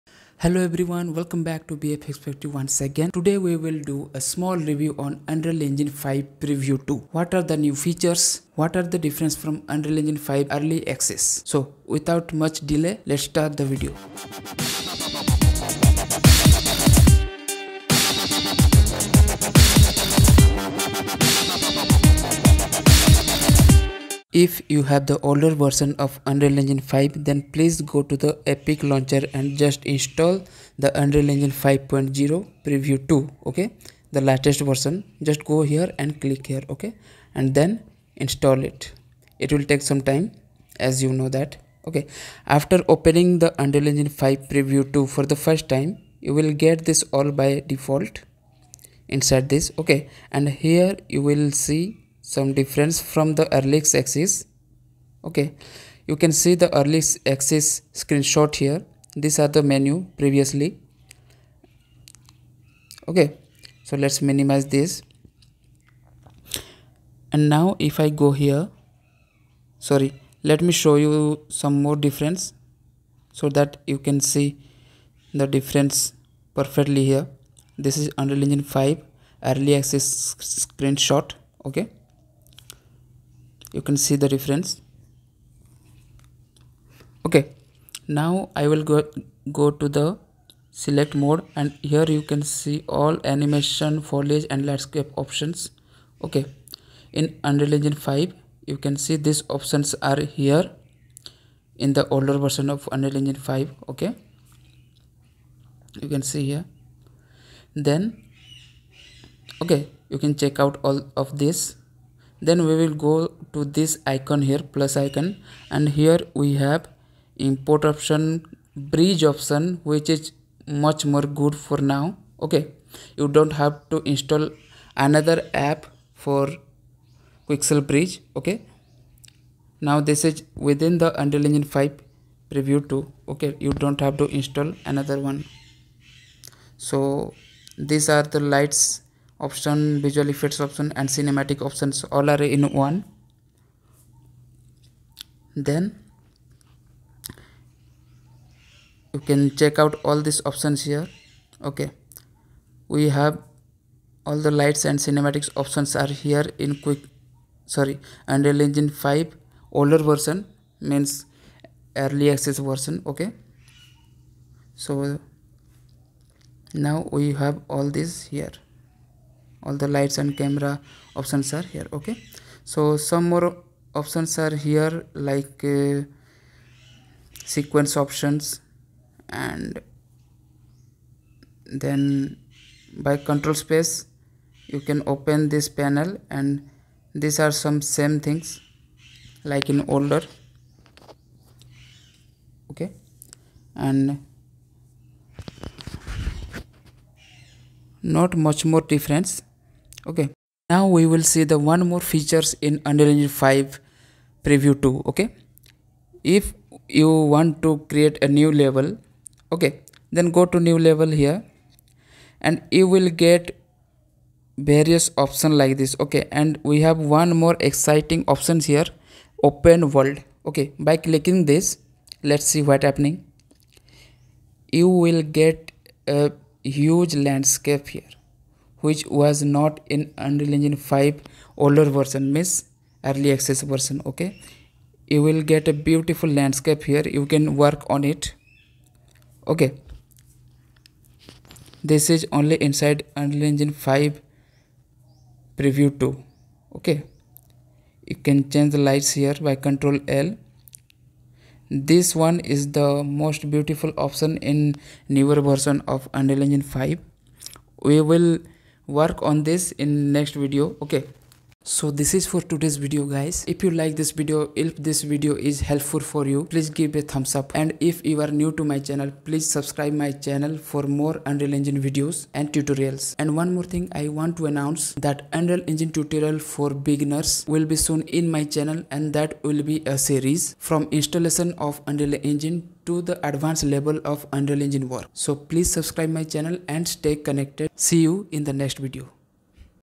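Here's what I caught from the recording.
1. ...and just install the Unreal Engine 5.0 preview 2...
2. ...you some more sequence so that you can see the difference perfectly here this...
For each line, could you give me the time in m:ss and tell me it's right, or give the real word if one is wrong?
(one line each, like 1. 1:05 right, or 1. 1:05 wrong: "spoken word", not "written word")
1. 0:29 right
2. 1:11 wrong: "difference", not "sequence".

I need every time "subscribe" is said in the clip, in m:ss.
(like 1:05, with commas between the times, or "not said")
4:29, 4:45.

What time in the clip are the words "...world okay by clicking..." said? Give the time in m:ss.
3:39.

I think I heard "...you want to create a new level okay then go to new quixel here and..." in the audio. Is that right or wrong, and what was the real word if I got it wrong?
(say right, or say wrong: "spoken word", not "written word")
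wrong: "level", not "quixel".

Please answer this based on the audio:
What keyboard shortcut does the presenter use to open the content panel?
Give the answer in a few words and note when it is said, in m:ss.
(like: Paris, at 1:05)
Control space, at 3:03.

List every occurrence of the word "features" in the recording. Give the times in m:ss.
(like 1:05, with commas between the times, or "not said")
0:07, 3:22.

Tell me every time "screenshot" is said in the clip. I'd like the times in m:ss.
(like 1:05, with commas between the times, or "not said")
0:58, 1:20.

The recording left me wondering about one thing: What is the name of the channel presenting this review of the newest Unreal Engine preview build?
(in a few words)
BFX Factory.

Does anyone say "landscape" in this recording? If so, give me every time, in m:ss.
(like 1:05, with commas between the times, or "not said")
1:34, 3:47, 3:56.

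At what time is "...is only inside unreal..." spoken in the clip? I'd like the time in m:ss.
4:02.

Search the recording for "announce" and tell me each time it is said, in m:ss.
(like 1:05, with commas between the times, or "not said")
4:34.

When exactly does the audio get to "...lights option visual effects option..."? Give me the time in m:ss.
2:18.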